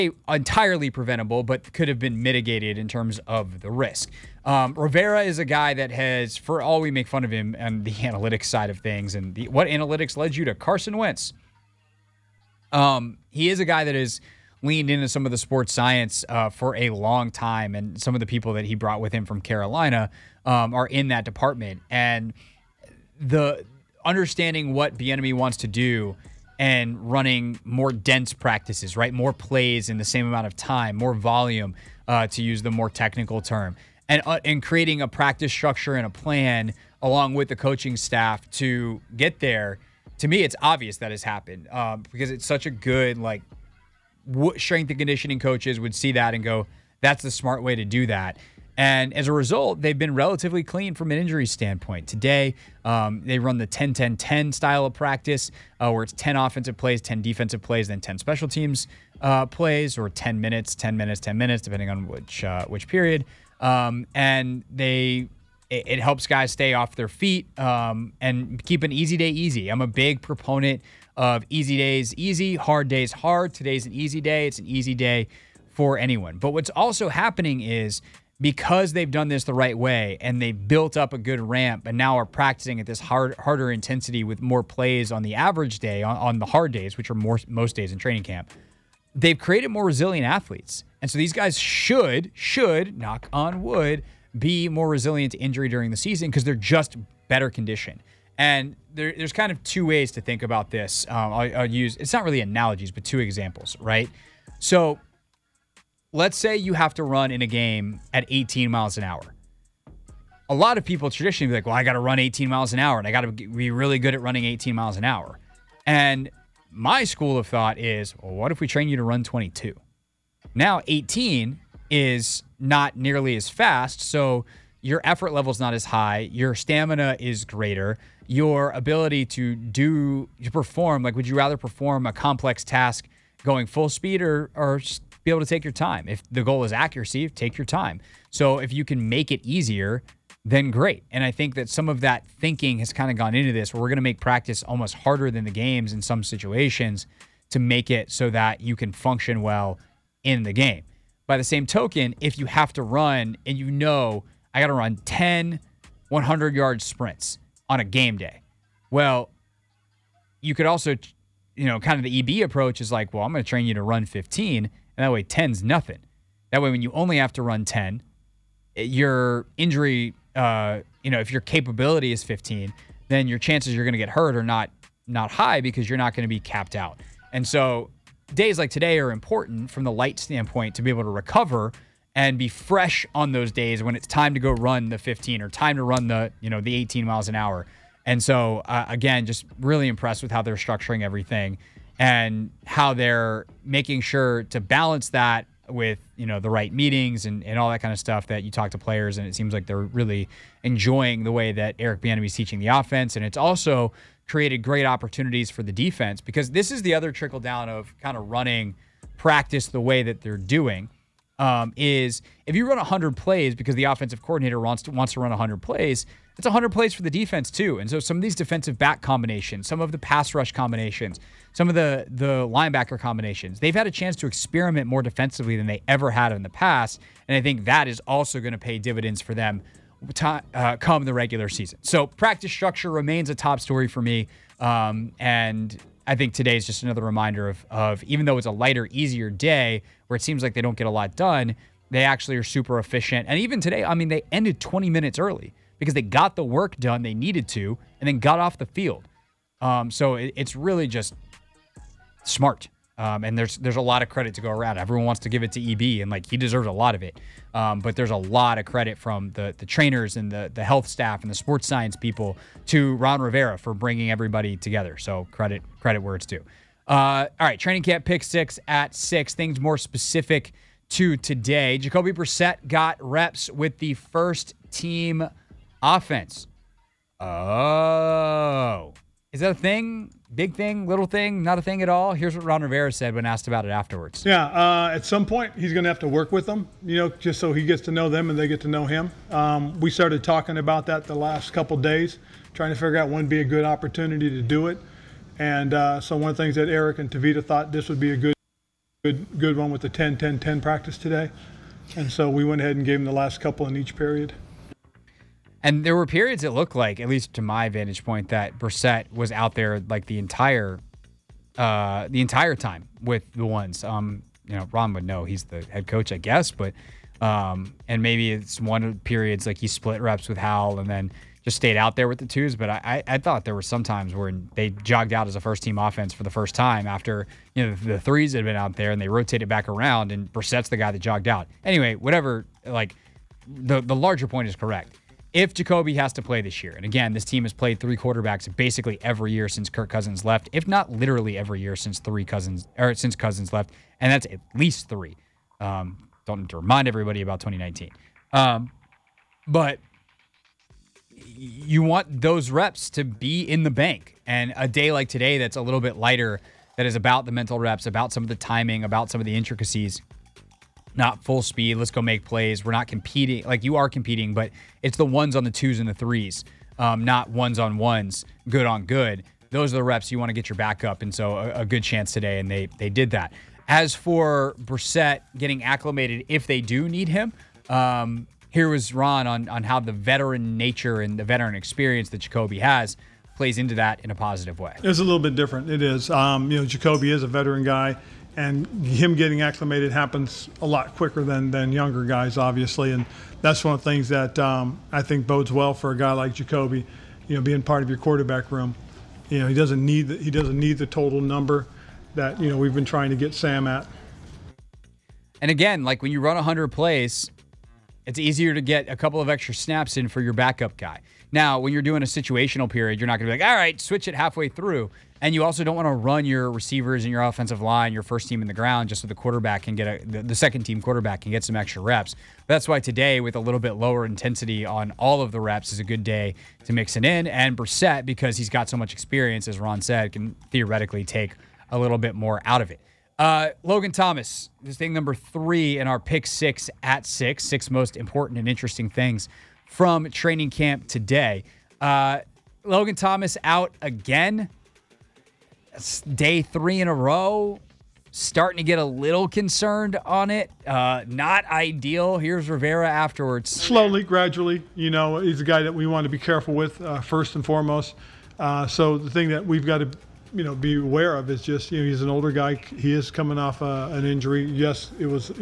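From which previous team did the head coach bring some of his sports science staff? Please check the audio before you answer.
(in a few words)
Carolina.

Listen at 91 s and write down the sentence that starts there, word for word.
And so these guys should, should, knock on wood, be more resilient to injury during the season because they're just better conditioned.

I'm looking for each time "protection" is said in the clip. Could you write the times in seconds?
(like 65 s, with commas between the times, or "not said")
not said.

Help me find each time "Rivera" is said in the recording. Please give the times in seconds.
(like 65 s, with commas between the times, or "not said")
4 s, 263 s, 282 s, 452 s.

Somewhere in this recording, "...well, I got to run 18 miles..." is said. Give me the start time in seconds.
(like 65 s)
111 s.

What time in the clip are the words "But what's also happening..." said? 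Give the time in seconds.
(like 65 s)
76 s.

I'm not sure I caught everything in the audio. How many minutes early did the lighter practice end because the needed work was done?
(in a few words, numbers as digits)
20.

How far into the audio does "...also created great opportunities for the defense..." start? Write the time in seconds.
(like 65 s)
203 s.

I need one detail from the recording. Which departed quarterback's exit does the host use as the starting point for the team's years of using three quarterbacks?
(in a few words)
Kirk Cousins.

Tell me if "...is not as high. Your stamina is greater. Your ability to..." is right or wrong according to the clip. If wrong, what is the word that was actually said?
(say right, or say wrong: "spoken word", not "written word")
right.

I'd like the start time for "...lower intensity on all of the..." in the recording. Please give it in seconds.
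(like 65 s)
423 s.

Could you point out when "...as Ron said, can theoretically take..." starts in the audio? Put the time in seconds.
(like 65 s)
429 s.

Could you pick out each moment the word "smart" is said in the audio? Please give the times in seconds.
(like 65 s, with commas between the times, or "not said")
47 s, 252 s.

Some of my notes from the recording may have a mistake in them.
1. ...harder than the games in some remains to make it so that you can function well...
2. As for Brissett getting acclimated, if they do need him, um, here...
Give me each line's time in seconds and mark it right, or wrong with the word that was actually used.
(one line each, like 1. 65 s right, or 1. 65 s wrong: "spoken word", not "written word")
1. 144 s wrong: "situations", not "remains"
2. 373 s right.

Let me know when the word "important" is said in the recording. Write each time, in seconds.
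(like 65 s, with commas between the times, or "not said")
179 s, 437 s.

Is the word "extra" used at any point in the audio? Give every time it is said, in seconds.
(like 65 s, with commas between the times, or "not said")
409 s, 421 s.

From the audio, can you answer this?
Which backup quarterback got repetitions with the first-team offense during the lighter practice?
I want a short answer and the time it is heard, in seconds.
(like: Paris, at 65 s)
Jacoby Brissett, at 271 s.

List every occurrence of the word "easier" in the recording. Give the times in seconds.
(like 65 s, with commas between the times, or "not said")
139 s, 238 s, 408 s.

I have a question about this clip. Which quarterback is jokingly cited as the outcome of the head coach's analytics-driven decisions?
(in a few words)
Carson Wentz.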